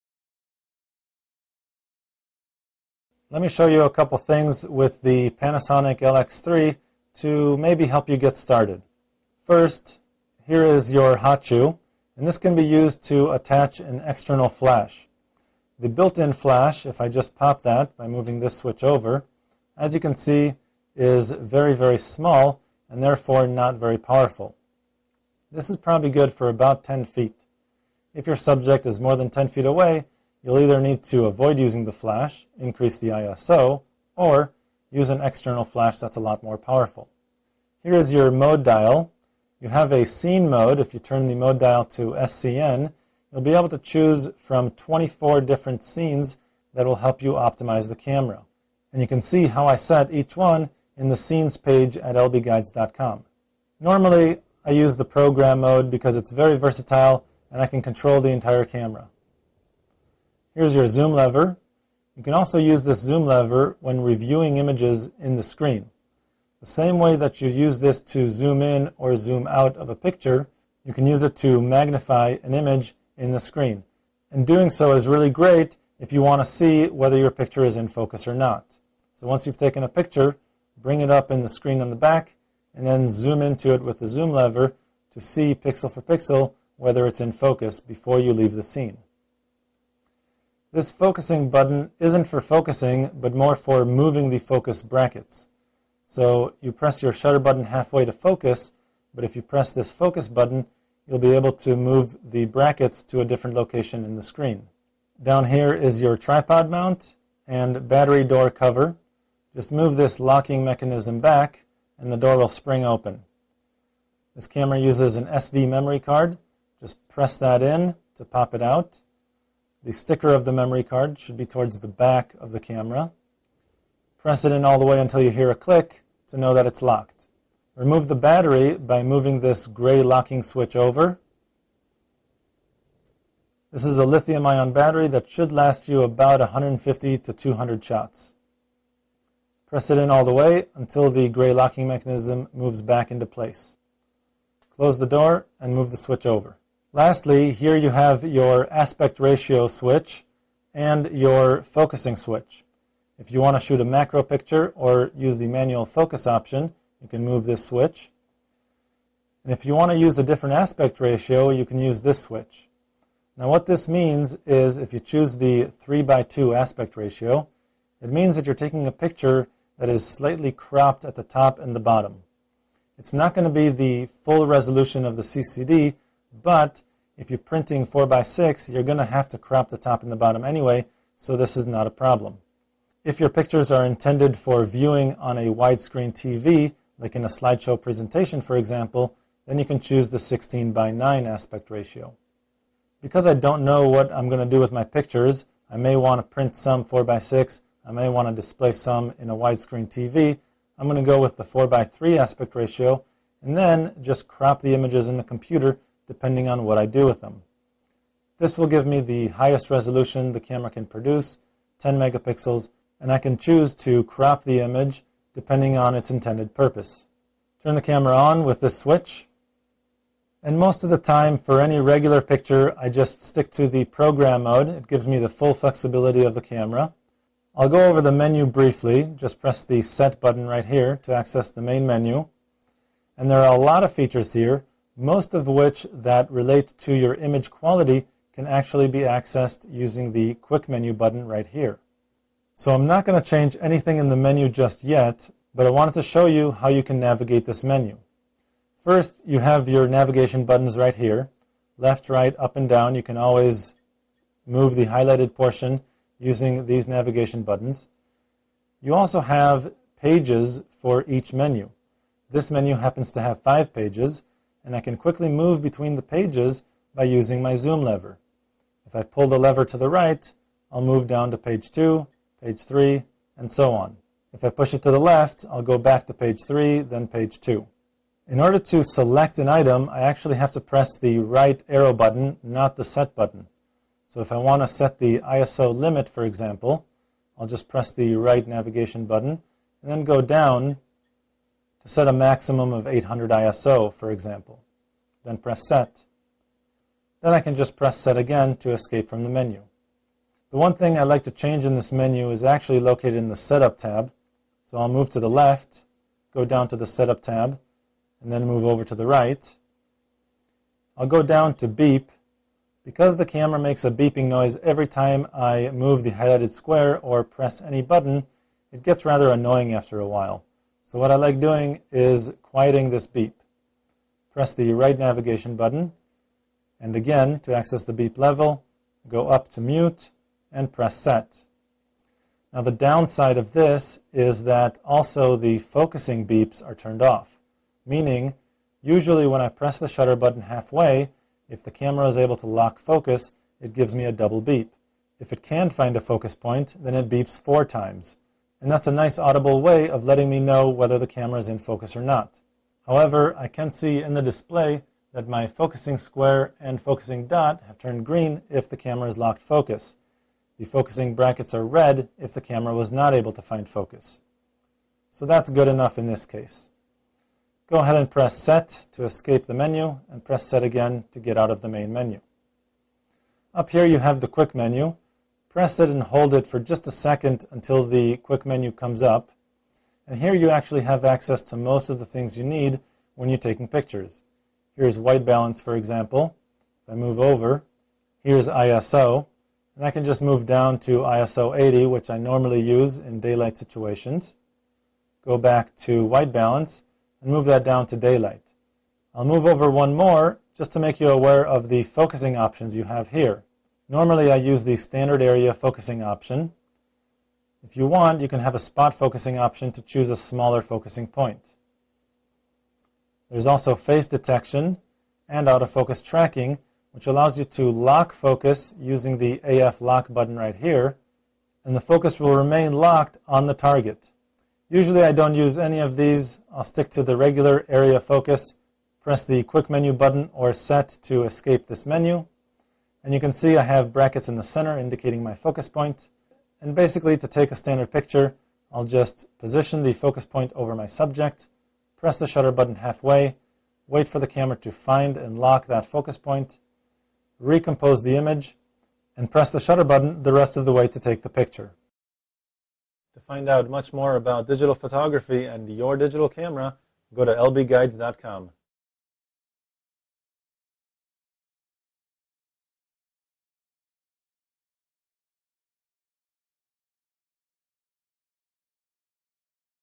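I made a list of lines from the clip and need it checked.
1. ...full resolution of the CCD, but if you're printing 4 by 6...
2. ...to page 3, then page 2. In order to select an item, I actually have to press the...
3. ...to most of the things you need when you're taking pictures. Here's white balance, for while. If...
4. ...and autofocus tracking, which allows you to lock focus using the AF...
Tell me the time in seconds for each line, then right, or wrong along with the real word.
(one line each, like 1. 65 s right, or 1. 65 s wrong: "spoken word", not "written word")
1. 174 s right
2. 276 s right
3. 381 s wrong: "example", not "while"
4. 415 s right.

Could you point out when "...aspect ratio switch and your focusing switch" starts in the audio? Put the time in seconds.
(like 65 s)
148 s.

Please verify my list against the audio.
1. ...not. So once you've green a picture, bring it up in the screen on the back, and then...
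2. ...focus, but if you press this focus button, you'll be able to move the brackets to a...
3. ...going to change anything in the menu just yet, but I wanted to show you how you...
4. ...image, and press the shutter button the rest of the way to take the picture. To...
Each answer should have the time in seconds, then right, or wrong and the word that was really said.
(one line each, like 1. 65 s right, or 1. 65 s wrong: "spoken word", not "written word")
1. 78 s wrong: "taken", not "green"
2. 98 s right
3. 243 s right
4. 448 s right.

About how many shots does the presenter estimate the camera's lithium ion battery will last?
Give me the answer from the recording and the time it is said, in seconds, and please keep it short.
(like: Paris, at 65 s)
150 to 200, at 136 s.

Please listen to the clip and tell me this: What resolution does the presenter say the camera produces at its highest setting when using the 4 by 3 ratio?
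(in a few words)
10 megapixels.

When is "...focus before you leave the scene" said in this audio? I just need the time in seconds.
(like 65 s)
87 s.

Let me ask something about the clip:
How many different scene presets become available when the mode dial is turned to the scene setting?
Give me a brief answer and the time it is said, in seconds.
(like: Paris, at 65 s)
24, at 44 s.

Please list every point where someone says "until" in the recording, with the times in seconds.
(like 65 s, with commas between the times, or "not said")
124 s, 140 s, 377 s.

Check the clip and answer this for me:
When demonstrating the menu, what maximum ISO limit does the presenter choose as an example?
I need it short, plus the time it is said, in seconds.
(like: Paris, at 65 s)
800, at 292 s.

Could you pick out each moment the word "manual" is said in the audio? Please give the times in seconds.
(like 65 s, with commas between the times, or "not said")
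155 s.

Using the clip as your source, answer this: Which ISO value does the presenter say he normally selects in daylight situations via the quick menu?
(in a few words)
ISO 80.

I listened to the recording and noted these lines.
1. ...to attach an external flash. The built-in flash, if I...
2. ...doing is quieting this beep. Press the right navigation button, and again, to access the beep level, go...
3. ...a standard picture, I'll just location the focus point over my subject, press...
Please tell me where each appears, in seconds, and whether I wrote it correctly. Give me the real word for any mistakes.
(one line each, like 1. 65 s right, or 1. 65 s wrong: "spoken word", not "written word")
1. 13 s right
2. 321 s right
3. 437 s wrong: "position", not "location".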